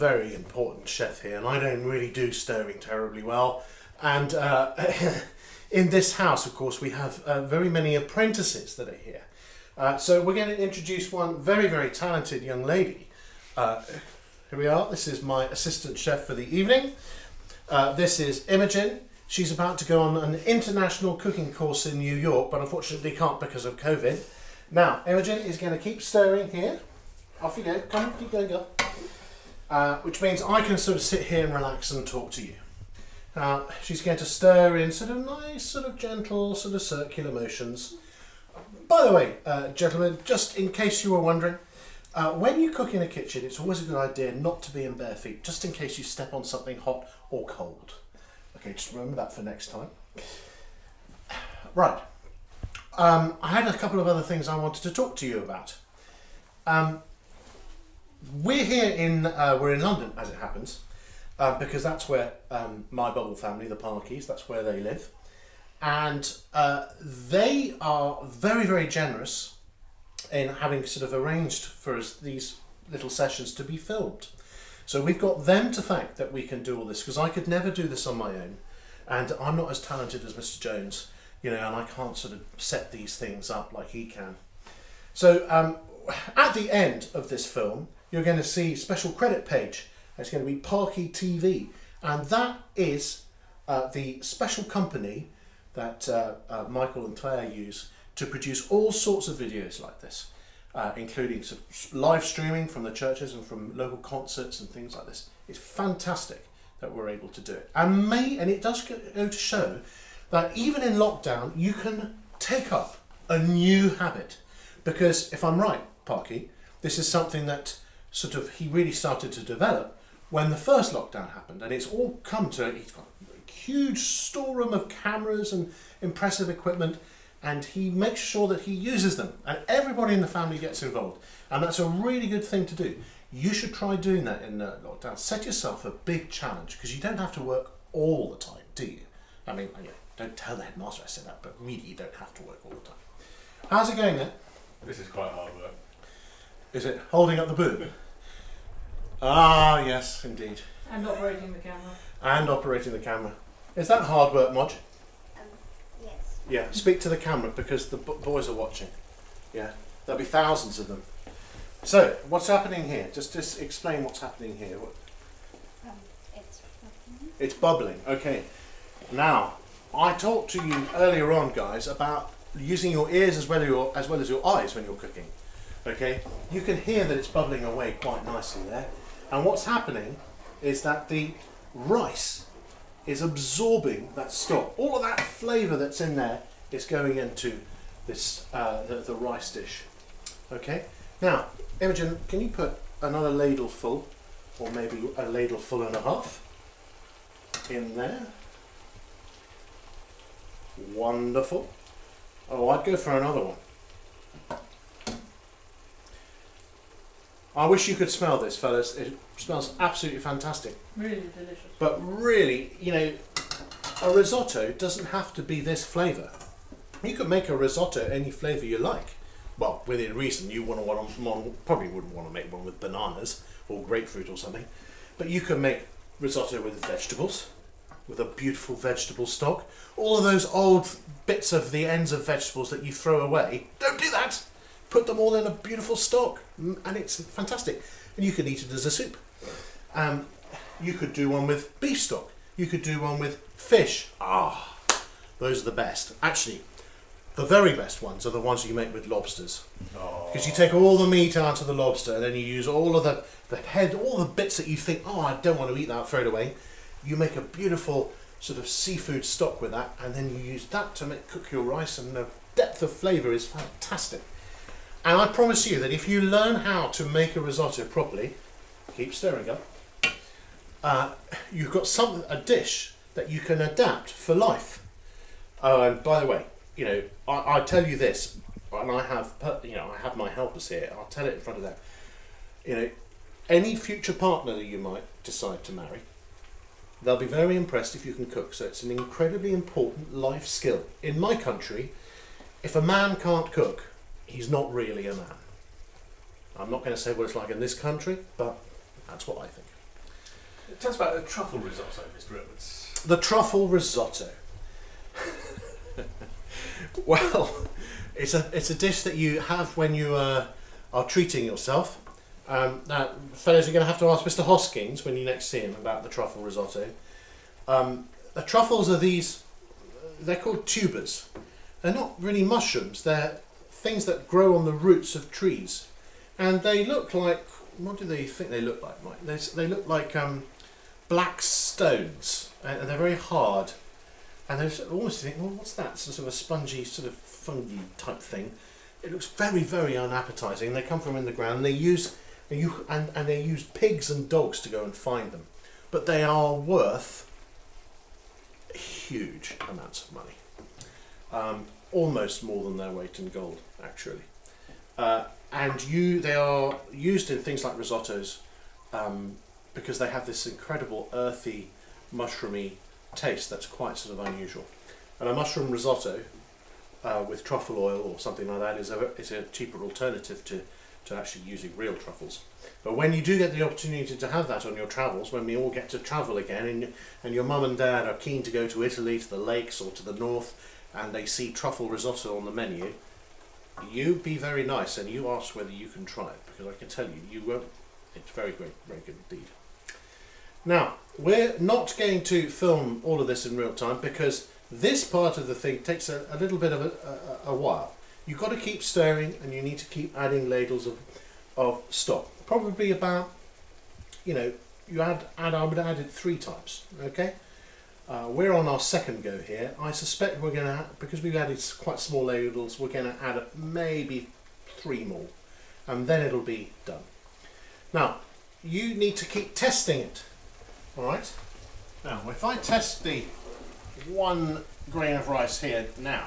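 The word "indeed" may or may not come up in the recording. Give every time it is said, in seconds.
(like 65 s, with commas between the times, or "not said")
150 s, 389 s.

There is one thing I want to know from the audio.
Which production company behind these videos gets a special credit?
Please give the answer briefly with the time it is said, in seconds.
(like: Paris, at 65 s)
Parky TV, at 90 s.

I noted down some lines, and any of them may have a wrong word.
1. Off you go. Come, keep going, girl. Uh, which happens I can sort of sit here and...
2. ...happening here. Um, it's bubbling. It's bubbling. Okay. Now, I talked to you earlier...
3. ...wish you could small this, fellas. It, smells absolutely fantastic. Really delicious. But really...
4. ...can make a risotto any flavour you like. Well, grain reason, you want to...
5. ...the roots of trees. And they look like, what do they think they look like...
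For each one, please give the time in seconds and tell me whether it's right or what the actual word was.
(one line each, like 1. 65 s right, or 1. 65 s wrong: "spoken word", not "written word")
1. 27 s wrong: "means", not "happens"
2. 164 s right
3. 207 s wrong: "smell", not "small"
4. 217 s wrong: "within", not "grain"
5. 324 s right.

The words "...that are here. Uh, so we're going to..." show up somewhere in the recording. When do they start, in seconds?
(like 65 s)
8 s.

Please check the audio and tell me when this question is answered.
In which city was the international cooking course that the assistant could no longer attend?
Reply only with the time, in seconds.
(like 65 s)
21 s.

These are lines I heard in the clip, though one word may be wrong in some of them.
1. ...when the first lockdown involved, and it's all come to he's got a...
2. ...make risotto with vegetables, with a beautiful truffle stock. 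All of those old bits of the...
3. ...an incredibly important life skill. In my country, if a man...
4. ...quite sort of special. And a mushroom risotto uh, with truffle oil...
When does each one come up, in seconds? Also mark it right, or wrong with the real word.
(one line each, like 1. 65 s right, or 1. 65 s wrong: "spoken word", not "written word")
1. 120 s wrong: "happened", not "involved"
2. 225 s wrong: "vegetable", not "truffle"
3. 288 s right
4. 363 s wrong: "unusual", not "special".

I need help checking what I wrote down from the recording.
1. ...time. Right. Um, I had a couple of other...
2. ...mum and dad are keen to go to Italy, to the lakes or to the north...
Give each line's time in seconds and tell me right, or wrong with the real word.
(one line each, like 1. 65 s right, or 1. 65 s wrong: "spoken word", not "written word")
1. 49 s right
2. 377 s right.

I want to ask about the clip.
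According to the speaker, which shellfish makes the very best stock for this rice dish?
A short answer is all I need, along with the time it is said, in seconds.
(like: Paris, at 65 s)
lobsters, at 249 s.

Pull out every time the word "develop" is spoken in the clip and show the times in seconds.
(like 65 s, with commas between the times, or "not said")
119 s.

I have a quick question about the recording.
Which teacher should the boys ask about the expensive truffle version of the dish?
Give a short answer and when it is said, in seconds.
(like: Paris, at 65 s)
Mr. Hoskins, at 314 s.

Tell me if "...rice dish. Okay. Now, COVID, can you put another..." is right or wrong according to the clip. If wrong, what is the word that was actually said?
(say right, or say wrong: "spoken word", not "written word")
wrong: "Imogen", not "COVID".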